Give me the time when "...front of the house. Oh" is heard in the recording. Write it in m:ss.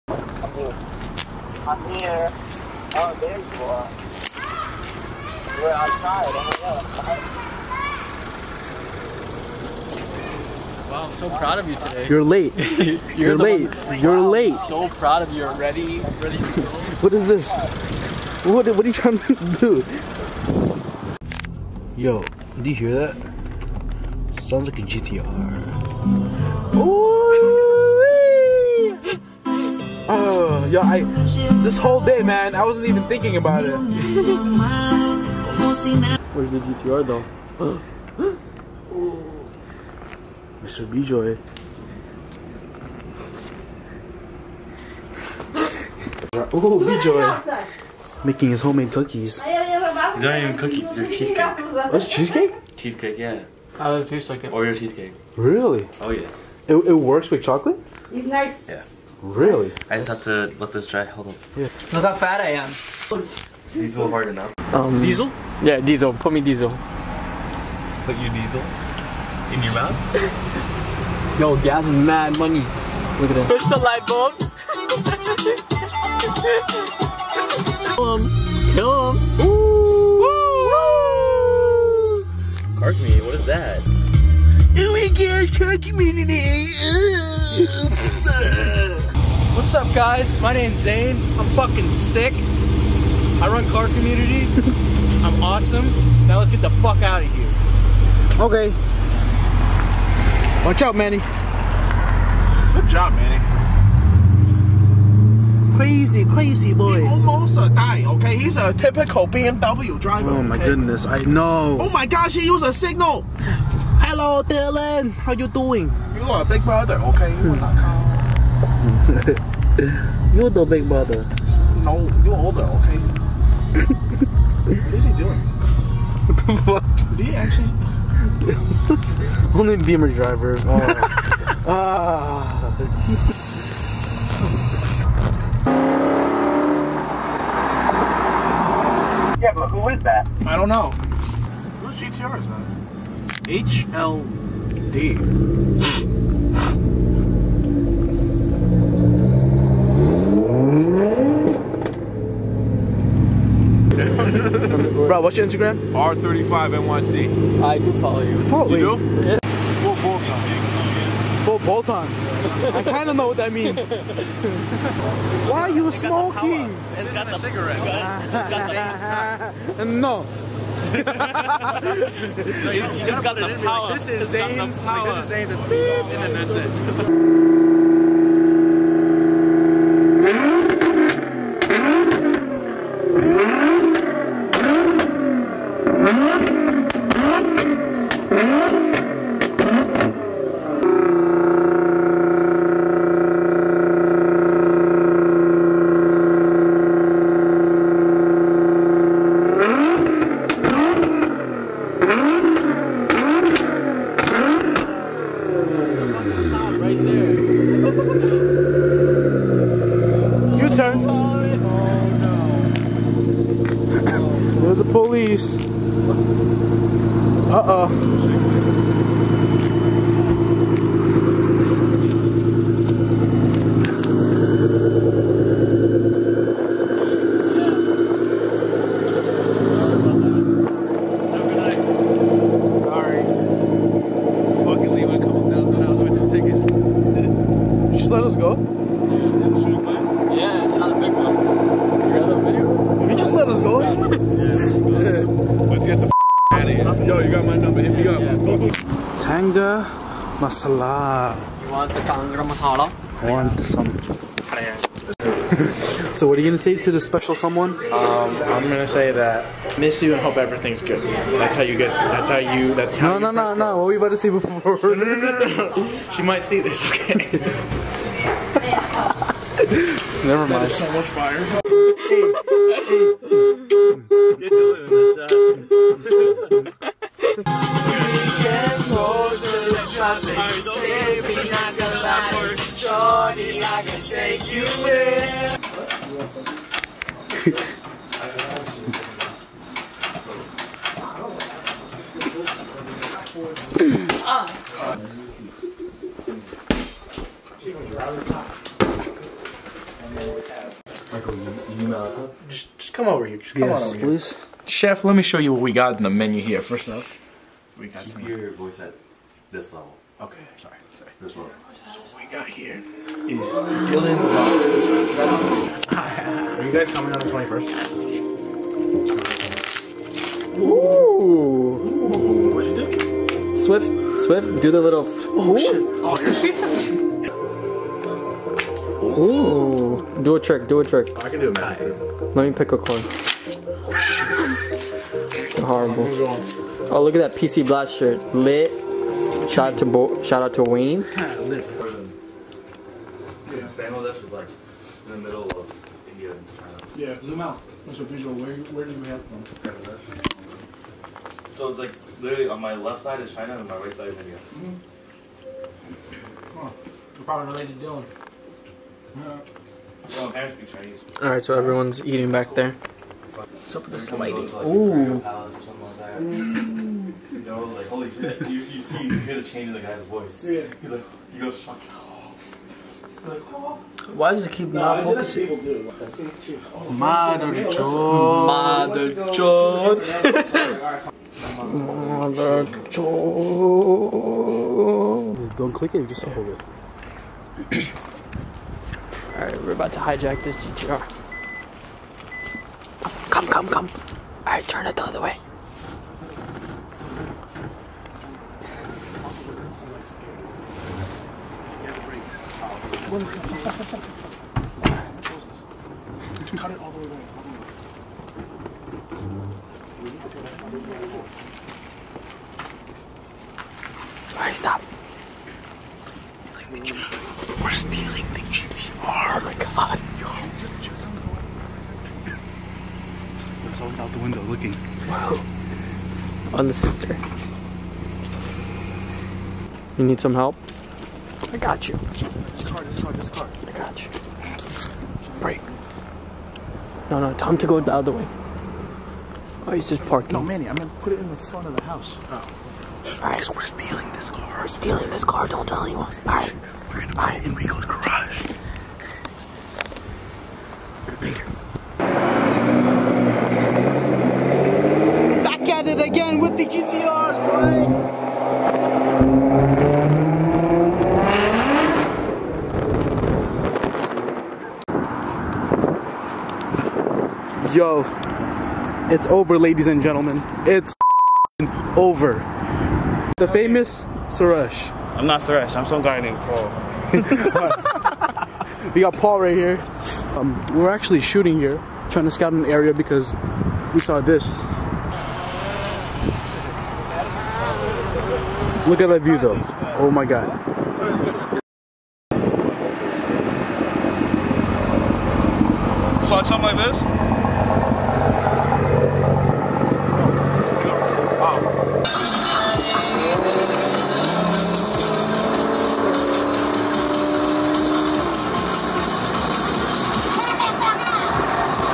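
7:21.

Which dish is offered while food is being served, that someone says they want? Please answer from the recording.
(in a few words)
Kangra masala.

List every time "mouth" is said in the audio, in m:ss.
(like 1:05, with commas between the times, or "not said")
1:09.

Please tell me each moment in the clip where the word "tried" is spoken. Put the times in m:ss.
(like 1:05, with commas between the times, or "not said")
0:10.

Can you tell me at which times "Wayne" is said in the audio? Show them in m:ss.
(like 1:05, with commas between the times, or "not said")
5:40.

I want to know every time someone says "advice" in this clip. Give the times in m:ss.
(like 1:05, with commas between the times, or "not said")
not said.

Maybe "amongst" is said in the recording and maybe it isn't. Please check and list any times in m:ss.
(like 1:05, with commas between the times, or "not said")
not said.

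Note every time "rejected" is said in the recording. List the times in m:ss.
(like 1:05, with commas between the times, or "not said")
not said.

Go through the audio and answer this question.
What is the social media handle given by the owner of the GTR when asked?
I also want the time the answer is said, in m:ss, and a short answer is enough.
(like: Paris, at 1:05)
R35NYC, at 2:35.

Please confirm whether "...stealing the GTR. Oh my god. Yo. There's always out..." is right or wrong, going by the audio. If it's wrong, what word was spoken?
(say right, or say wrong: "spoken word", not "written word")
right.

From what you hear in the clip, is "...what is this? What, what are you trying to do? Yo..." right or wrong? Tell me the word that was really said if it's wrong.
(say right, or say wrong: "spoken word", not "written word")
right.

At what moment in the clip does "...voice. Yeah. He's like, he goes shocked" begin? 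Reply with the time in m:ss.
6:10.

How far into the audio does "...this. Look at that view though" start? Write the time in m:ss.
8:04.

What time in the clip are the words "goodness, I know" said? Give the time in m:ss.
1:50.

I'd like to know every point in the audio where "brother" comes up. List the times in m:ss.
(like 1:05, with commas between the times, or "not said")
1:56, 2:00.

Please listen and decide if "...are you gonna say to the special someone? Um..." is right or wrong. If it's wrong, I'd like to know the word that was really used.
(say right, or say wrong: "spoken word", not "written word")
right.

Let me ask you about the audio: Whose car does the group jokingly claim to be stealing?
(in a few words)
Enrico.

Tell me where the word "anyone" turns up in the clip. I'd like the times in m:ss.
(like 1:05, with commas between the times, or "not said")
7:25.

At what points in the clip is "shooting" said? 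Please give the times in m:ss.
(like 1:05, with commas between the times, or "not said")
8:01.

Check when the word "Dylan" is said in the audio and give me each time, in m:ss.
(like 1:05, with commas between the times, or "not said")
1:54, 5:13, 5:57.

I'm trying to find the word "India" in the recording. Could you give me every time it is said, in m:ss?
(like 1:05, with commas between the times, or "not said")
5:46, 5:54.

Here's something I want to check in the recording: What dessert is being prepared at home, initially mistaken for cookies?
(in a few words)
Oreo cheesecake.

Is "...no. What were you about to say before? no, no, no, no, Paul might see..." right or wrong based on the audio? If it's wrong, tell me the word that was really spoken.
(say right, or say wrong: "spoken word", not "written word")
wrong: "She", not "Paul".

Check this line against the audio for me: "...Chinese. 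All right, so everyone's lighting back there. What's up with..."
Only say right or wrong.
wrong.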